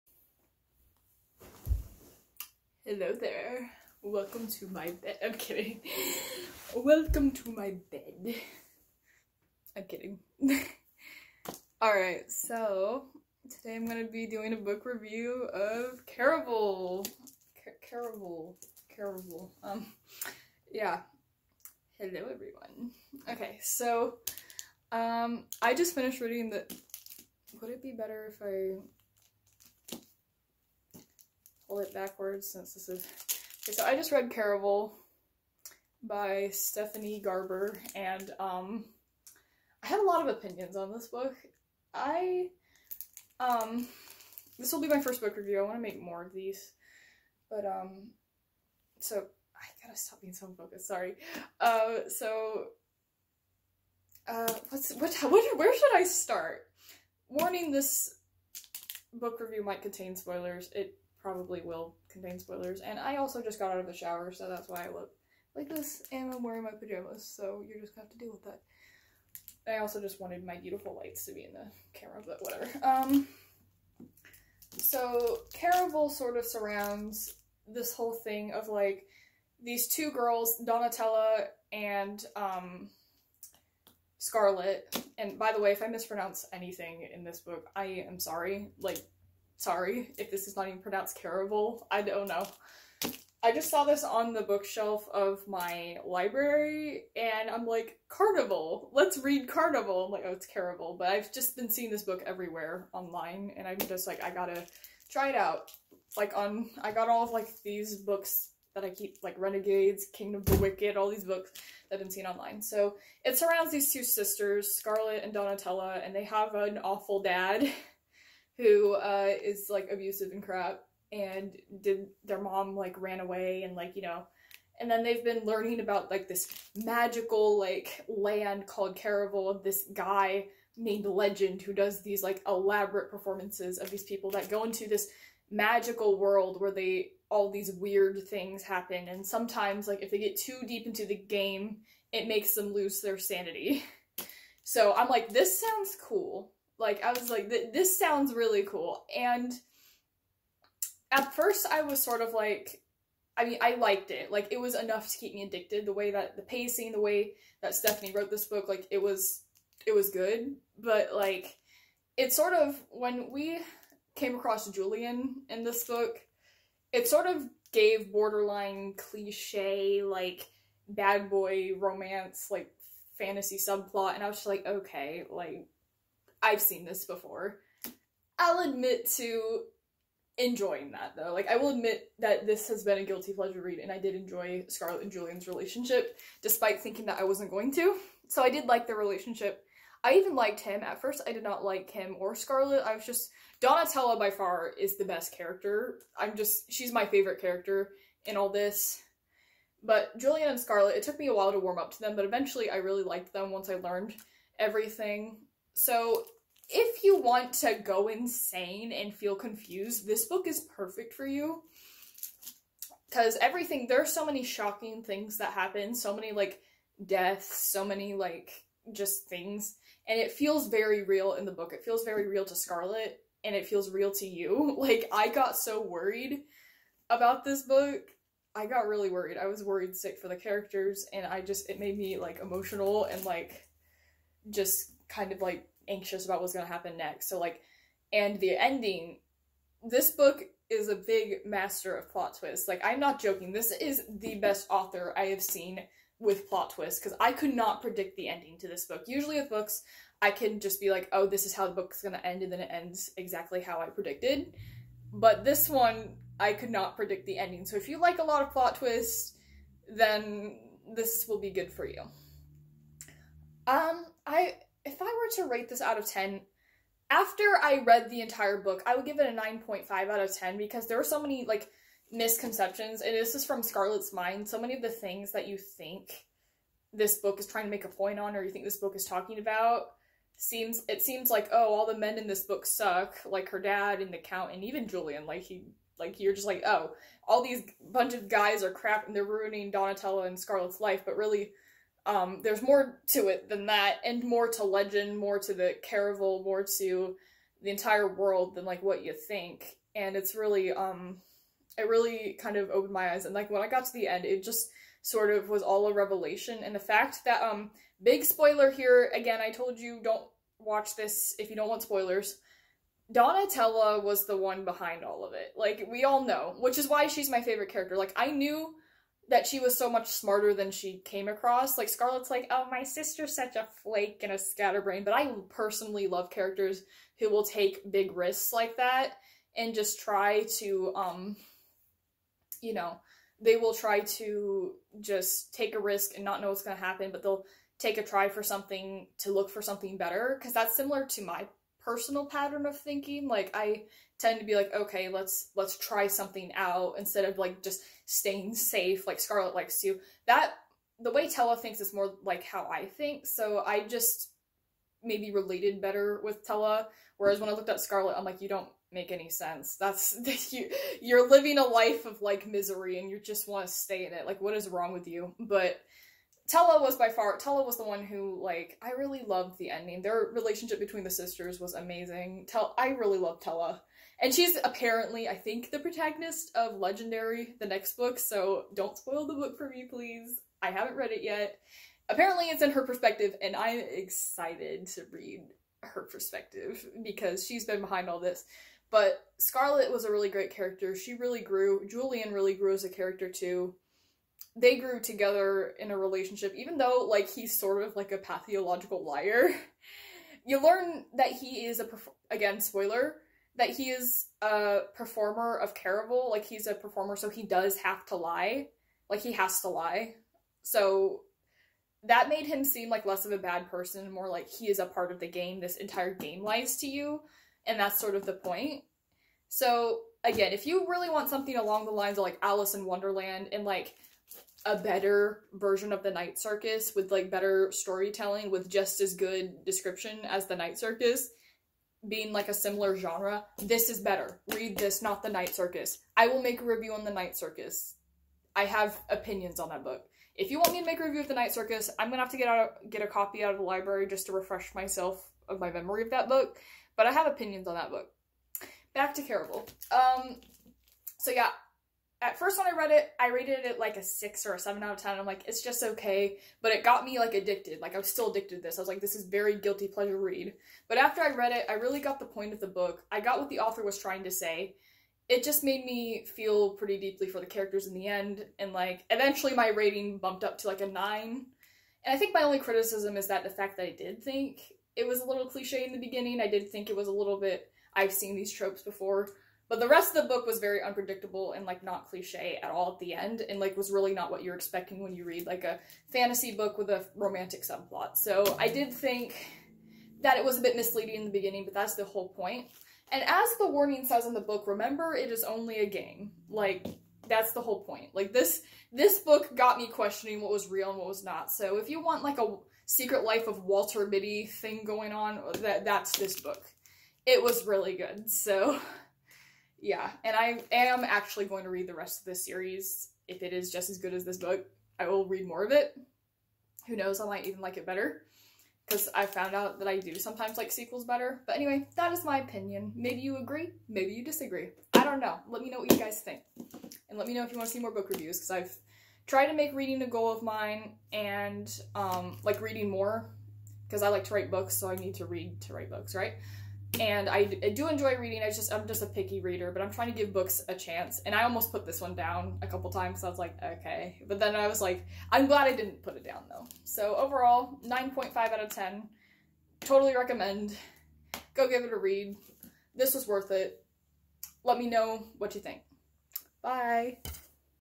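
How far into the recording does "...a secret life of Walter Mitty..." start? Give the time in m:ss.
8:22.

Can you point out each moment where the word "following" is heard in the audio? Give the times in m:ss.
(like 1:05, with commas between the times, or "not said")
not said.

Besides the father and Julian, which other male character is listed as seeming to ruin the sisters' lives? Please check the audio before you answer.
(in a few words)
the count.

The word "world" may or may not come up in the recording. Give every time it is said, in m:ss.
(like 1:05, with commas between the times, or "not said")
2:16, 4:58.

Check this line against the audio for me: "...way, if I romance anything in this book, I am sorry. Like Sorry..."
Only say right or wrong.
wrong.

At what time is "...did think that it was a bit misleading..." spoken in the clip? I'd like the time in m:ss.
8:08.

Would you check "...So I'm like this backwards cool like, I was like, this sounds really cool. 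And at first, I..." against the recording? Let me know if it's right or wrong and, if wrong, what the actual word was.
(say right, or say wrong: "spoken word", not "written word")
wrong: "sounds", not "backwards".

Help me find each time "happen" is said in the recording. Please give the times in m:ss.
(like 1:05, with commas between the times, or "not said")
2:18, 3:35, 3:56, 5:36.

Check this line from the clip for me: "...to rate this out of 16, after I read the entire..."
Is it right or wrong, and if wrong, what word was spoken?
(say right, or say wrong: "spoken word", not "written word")
wrong: "10", not "16".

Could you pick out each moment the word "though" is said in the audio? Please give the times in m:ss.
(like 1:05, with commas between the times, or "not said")
3:01, 6:36, 9:06.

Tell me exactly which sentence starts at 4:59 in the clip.
And it's really, um, it really kind of opened my eyes.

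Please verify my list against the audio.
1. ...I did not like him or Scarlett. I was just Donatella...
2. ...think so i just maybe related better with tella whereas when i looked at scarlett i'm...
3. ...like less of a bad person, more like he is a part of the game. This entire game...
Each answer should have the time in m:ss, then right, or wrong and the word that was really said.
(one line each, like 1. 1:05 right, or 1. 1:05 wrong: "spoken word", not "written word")
1. 3:11 right
2. 5:52 right
3. 6:52 right.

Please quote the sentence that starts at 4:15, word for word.
But this one, I could not predict the ending.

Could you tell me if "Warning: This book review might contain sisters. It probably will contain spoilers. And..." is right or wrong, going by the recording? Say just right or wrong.
wrong.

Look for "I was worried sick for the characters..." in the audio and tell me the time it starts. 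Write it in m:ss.
3:49.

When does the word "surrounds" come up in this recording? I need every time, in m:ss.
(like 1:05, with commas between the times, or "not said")
1:16, 1:53.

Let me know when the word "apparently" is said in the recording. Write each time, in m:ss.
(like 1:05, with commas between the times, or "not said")
6:14, 6:22.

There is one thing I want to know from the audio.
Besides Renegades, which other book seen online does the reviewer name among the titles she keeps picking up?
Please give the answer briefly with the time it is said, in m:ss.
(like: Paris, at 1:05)
Kingdom of the Wicked, at 1:50.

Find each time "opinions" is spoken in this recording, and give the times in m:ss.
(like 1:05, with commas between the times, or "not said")
0:40, 7:19, 7:27, 8:42.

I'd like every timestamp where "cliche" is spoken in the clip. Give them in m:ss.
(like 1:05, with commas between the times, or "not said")
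2:48, 7:55, 8:02.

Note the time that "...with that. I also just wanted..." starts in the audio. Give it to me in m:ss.
1:08.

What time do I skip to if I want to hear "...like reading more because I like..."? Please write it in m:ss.
8:52.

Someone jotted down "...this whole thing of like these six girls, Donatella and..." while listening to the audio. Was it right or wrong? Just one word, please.
wrong.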